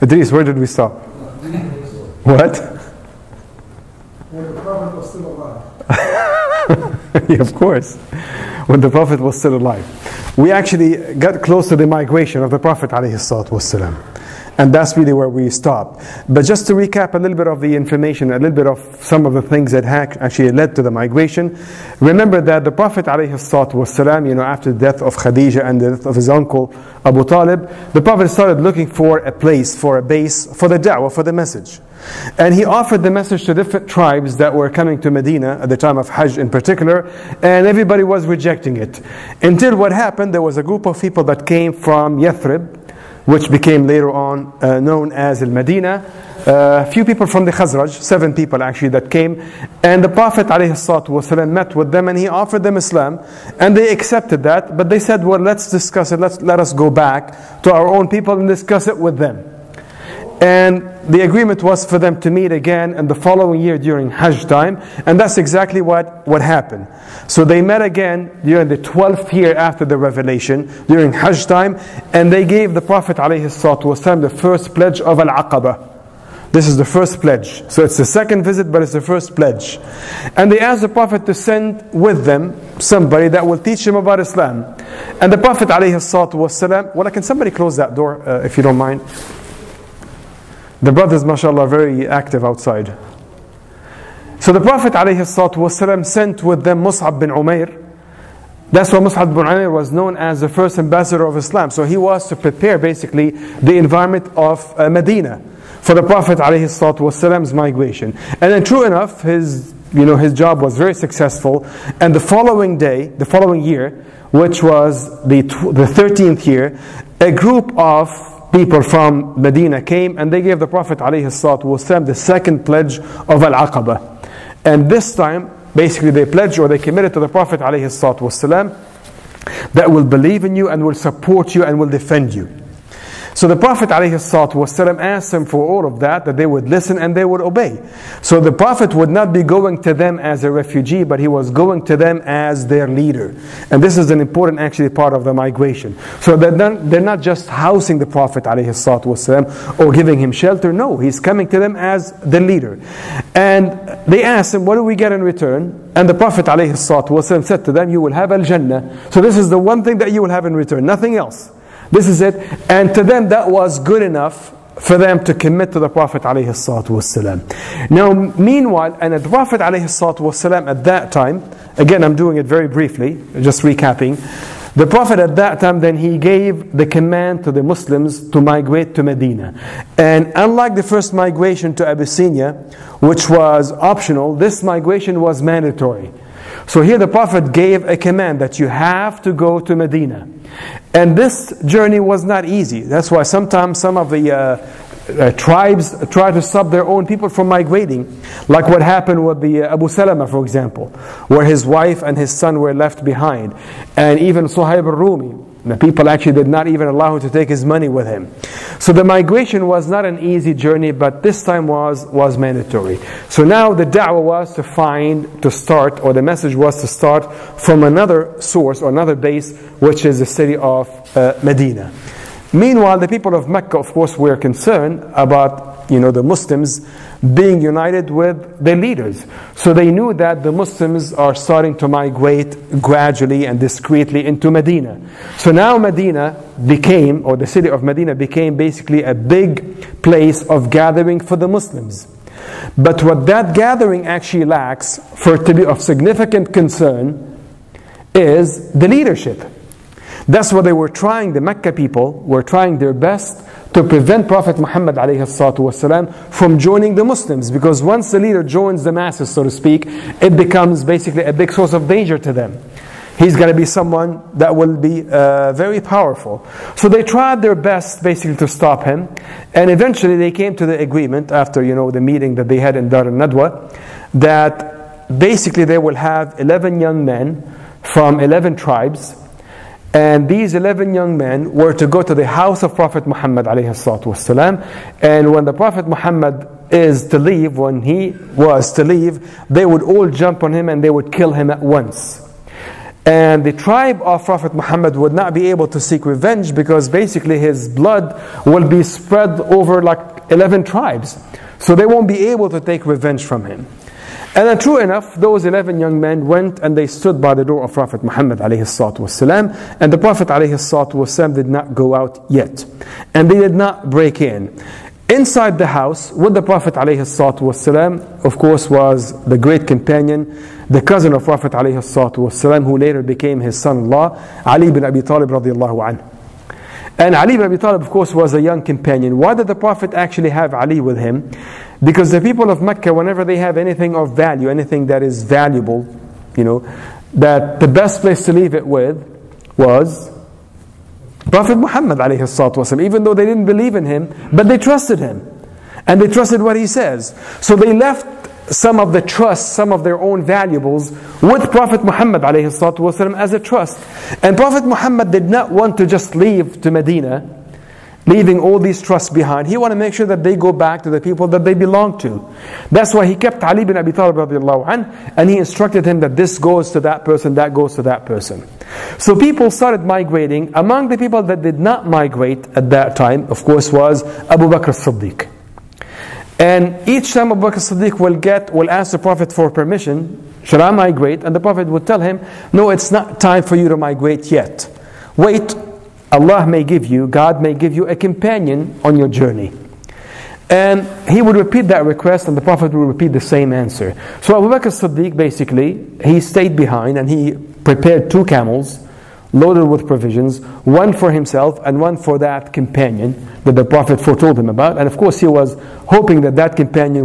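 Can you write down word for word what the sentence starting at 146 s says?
So they're not, they're not just housing the Prophet ﷺ or giving him shelter.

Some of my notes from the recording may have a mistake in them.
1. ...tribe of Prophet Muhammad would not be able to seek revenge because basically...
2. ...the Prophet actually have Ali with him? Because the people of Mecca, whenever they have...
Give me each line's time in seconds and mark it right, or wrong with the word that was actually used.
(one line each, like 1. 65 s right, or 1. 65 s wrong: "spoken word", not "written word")
1. 293 s right
2. 329 s right.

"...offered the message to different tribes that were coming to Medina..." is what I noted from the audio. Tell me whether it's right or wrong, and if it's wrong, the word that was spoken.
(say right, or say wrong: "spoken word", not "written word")
right.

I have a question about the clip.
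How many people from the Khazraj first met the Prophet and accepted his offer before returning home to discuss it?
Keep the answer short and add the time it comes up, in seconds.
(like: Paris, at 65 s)
7, at 48 s.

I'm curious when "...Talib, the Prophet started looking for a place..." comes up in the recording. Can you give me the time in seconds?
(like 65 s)
27 s.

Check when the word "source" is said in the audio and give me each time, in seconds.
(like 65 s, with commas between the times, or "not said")
218 s, 261 s.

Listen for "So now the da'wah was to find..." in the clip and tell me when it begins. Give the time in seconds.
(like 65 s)
213 s.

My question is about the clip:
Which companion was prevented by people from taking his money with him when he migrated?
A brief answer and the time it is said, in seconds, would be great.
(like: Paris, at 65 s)
Suhaib al-Rumi, at 204 s.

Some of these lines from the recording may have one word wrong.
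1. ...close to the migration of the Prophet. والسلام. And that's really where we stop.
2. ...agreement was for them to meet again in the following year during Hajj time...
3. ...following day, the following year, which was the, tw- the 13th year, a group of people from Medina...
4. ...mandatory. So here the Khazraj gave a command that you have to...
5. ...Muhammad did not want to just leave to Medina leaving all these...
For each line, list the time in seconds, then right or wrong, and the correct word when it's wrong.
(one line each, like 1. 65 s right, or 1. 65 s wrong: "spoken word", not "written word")
1. 11 s right
2. 61 s right
3. 112 s right
4. 185 s wrong: "Prophet", not "Khazraj"
5. 354 s right.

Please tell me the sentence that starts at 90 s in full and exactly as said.
The brothers, mashallah, are very active outside.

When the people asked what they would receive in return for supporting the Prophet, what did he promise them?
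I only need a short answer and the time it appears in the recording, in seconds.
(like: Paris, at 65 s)
Al-Jannah, at 158 s.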